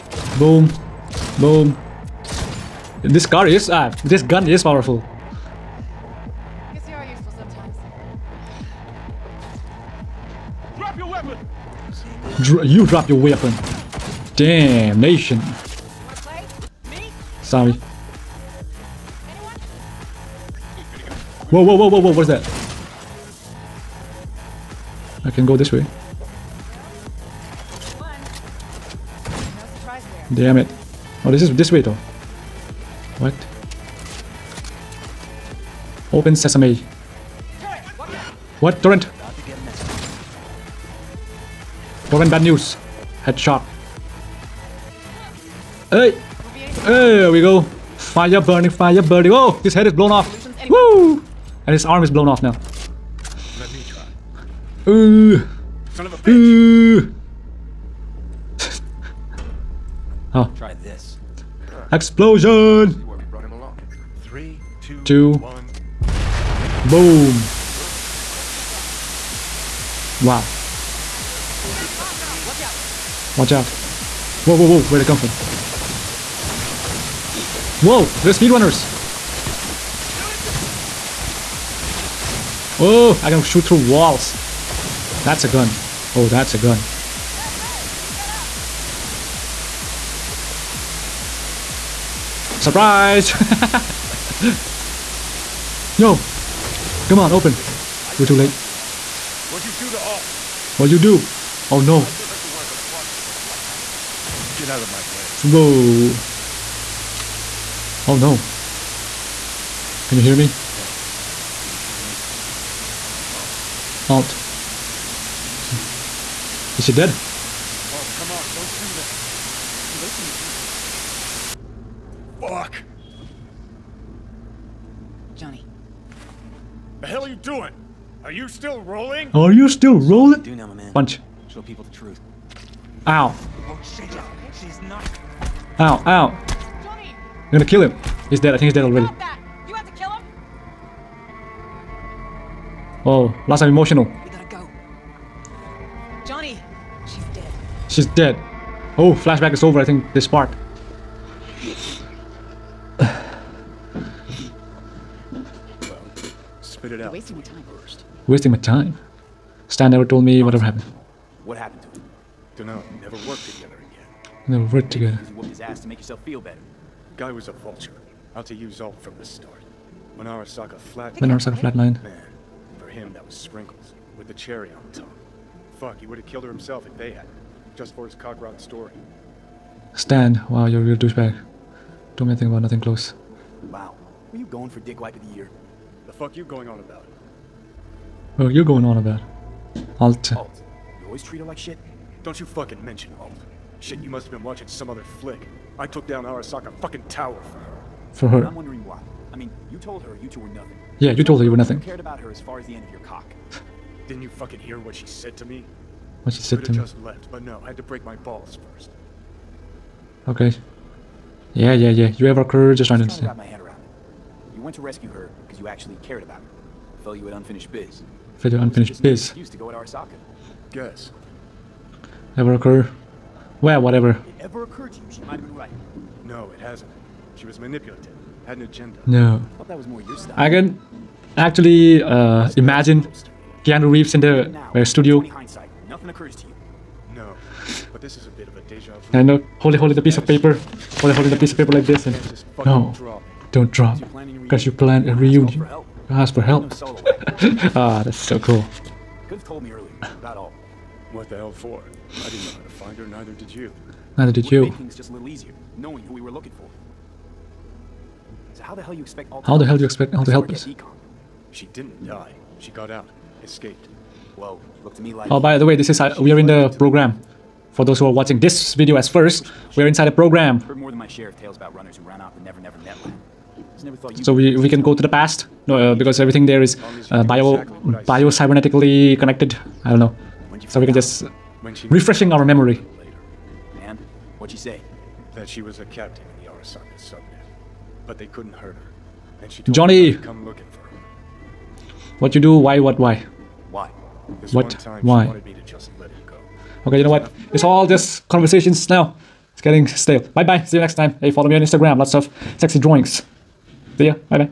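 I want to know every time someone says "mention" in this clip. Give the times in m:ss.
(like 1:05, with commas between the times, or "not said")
3:12.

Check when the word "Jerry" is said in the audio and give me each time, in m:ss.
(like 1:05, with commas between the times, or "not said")
not said.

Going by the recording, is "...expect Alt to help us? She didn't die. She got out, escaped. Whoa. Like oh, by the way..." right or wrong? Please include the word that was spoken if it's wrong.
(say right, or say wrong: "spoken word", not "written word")
right.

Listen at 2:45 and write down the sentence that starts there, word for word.
Because you whooped his ass to make yourself feel better.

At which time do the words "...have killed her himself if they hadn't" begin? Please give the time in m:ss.
2:56.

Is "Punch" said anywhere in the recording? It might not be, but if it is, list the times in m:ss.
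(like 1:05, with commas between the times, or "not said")
2:10.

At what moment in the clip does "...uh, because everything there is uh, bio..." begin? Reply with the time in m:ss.
4:35.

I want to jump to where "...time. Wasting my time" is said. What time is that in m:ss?
2:37.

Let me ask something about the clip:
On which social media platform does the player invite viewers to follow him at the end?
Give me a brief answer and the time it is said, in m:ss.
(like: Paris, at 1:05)
Instagram, at 5:01.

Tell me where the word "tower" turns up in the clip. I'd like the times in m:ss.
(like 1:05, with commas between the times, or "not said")
3:17.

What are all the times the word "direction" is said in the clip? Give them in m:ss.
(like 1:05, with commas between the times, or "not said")
not said.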